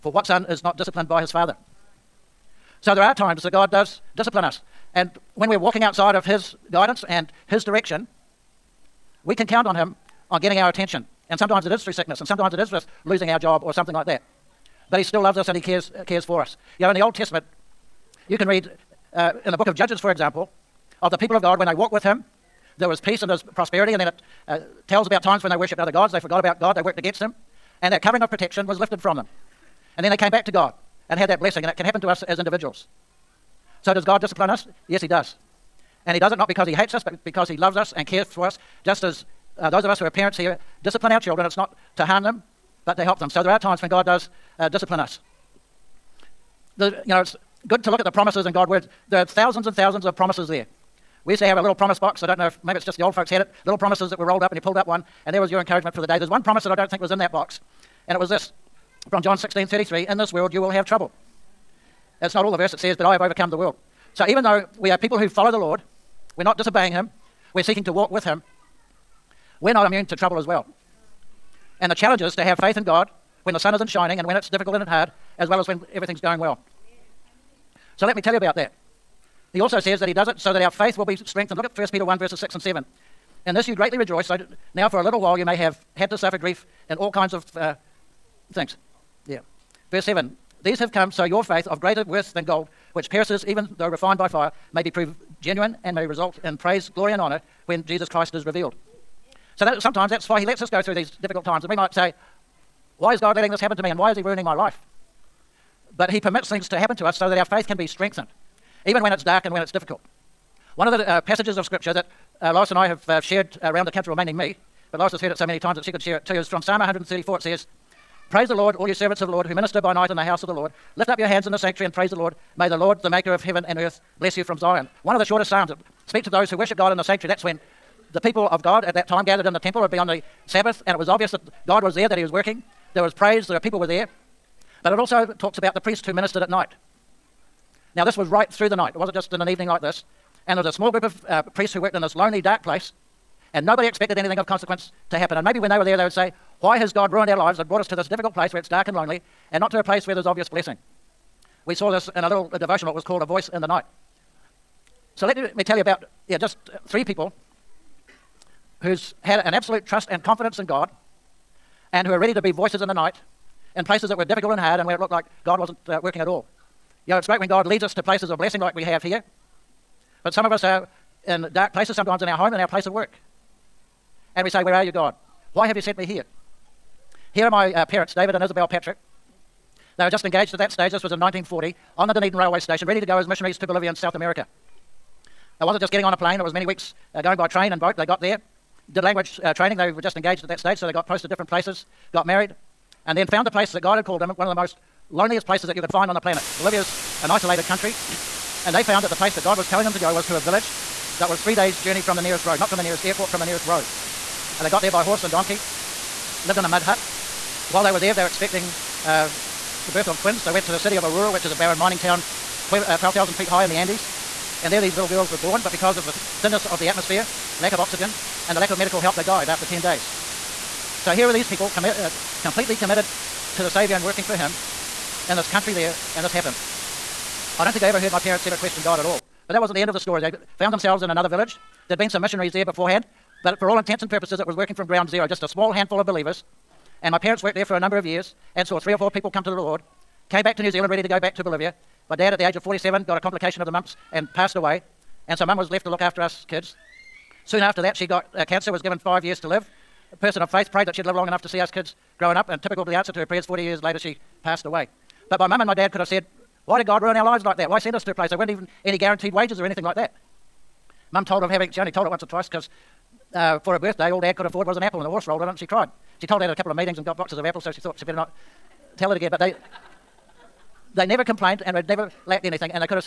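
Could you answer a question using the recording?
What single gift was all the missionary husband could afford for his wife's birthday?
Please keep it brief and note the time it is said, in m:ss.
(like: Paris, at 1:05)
An apple, at 4:24.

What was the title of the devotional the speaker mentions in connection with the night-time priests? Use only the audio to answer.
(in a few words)
A Voice in the Night.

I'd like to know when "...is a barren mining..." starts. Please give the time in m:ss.
3:31.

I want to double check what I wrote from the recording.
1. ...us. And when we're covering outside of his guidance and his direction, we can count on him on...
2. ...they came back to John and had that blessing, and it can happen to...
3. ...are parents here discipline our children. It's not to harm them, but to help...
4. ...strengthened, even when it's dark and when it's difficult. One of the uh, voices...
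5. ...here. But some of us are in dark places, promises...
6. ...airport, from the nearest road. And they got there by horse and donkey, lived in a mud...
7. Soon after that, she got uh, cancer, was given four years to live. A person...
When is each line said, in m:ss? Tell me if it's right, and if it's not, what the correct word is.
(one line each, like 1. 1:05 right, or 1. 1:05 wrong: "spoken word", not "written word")
1. 0:04 wrong: "walking", not "covering"
2. 0:30 wrong: "God", not "John"
3. 0:40 right
4. 1:47 wrong: "passages", not "voices"
5. 2:49 wrong: "sometimes", not "promises"
6. 3:23 right
7. 4:07 wrong: "five", not "four".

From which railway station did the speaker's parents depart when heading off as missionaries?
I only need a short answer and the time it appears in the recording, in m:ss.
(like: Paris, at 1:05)
Dunedin Railway Station, at 3:02.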